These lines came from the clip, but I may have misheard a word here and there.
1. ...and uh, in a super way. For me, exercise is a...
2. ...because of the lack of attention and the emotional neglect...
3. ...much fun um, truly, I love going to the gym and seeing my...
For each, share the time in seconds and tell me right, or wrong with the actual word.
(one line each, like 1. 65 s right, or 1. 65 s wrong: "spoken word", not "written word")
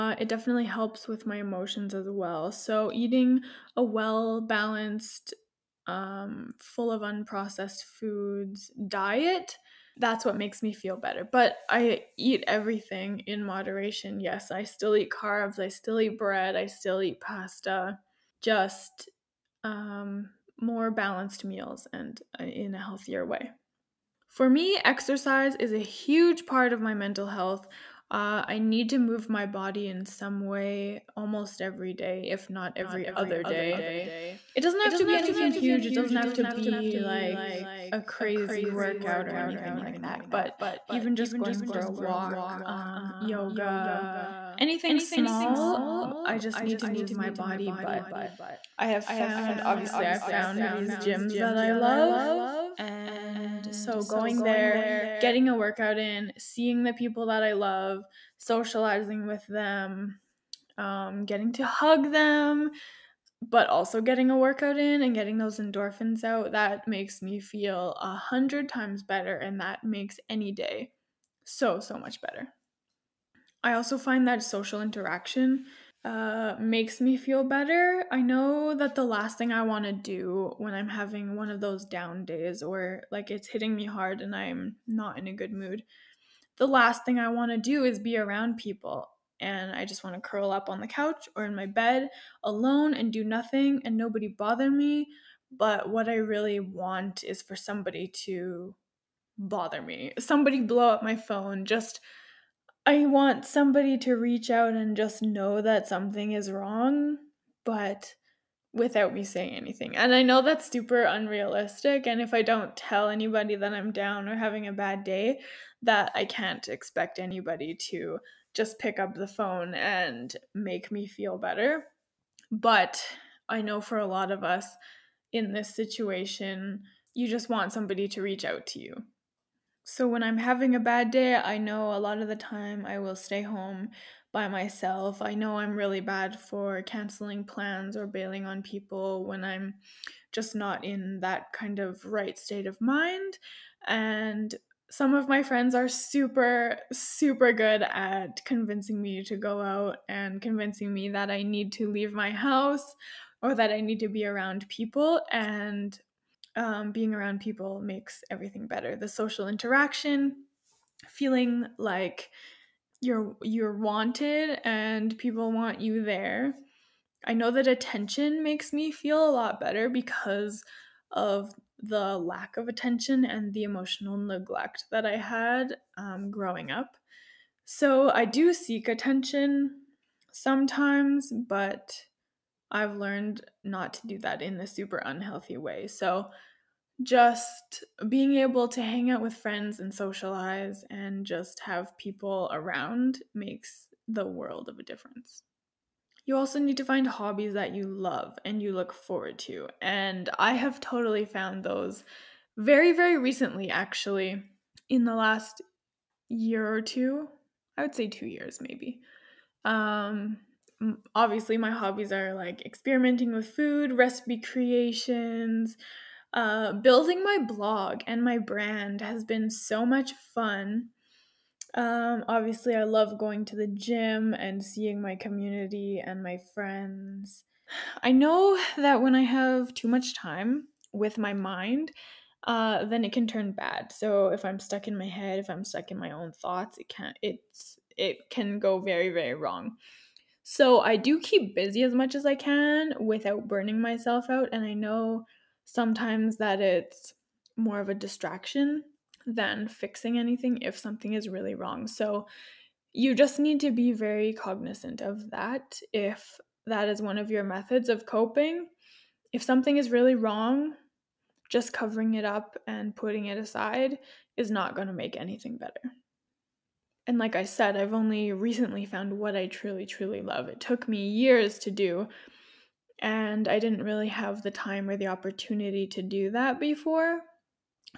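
1. 21 s wrong: "healthier", not "super"
2. 169 s right
3. 219 s wrong: "obviously", not "truly".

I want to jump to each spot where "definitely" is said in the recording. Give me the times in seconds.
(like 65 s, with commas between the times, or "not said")
0 s.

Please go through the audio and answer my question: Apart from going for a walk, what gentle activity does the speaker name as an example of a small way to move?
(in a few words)
Yoga.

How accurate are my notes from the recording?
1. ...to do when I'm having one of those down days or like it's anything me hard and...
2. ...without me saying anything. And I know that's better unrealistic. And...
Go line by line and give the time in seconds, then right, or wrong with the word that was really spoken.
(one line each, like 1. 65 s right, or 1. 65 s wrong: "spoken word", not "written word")
1. 79 s wrong: "hitting", not "anything"
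2. 108 s wrong: "super", not "better".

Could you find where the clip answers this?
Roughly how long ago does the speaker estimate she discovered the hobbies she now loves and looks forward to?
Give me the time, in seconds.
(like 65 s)
208 s.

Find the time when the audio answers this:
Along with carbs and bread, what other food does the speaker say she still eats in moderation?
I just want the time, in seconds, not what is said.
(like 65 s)
17 s.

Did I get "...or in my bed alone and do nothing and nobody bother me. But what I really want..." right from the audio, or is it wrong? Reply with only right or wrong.
right.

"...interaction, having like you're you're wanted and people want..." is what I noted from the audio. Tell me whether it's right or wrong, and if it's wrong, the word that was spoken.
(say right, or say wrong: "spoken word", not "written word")
wrong: "feeling", not "having".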